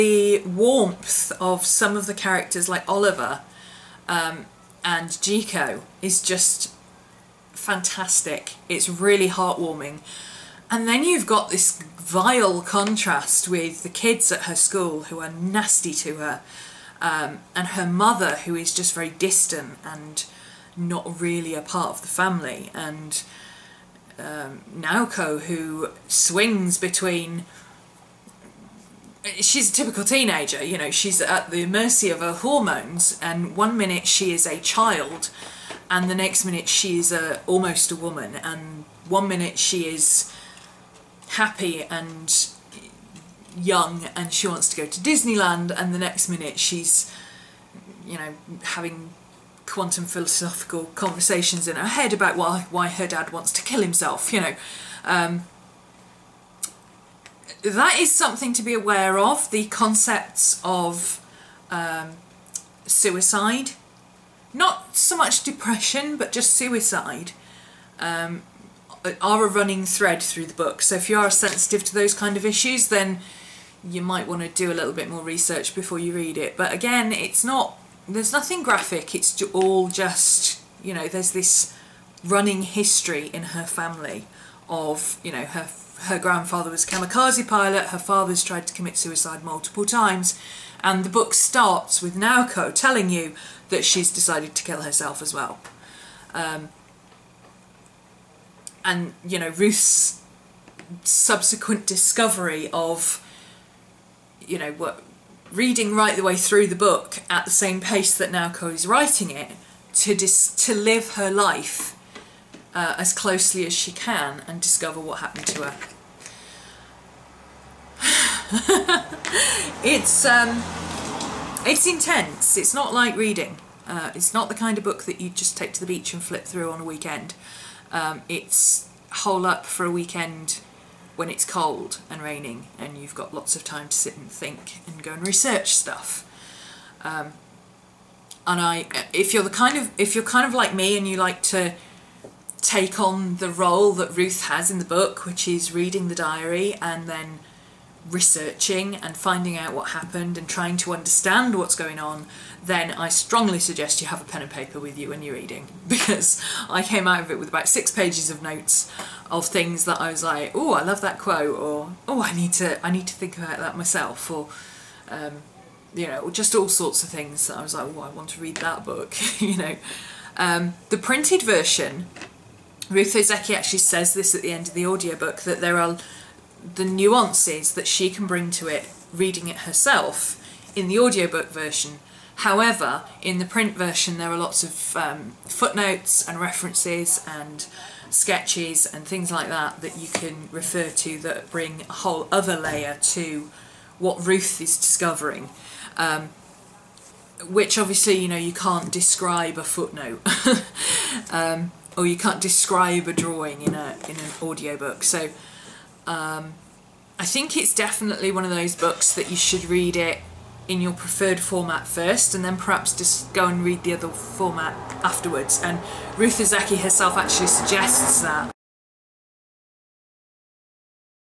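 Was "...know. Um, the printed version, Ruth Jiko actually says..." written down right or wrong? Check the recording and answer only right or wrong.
wrong.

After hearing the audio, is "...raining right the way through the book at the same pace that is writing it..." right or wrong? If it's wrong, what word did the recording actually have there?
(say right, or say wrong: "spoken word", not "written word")
wrong: "reading", not "raining".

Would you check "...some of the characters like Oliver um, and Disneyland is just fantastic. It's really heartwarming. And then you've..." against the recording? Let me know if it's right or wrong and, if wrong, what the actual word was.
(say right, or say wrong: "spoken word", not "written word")
wrong: "Jiko", not "Disneyland".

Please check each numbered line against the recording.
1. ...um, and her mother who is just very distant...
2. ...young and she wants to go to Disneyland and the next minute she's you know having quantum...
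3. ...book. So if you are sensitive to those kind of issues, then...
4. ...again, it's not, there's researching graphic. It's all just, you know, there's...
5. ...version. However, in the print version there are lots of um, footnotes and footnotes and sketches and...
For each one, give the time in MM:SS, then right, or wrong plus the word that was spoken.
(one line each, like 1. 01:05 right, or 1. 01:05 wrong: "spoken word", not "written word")
1. 00:17 right
2. 00:43 right
3. 01:10 right
4. 01:16 wrong: "nothing", not "researching"
5. 03:01 wrong: "references", not "footnotes".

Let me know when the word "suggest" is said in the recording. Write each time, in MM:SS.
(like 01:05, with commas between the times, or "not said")
02:33, 03:37.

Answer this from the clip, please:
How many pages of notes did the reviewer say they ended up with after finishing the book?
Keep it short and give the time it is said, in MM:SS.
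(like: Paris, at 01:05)
6, at 02:37.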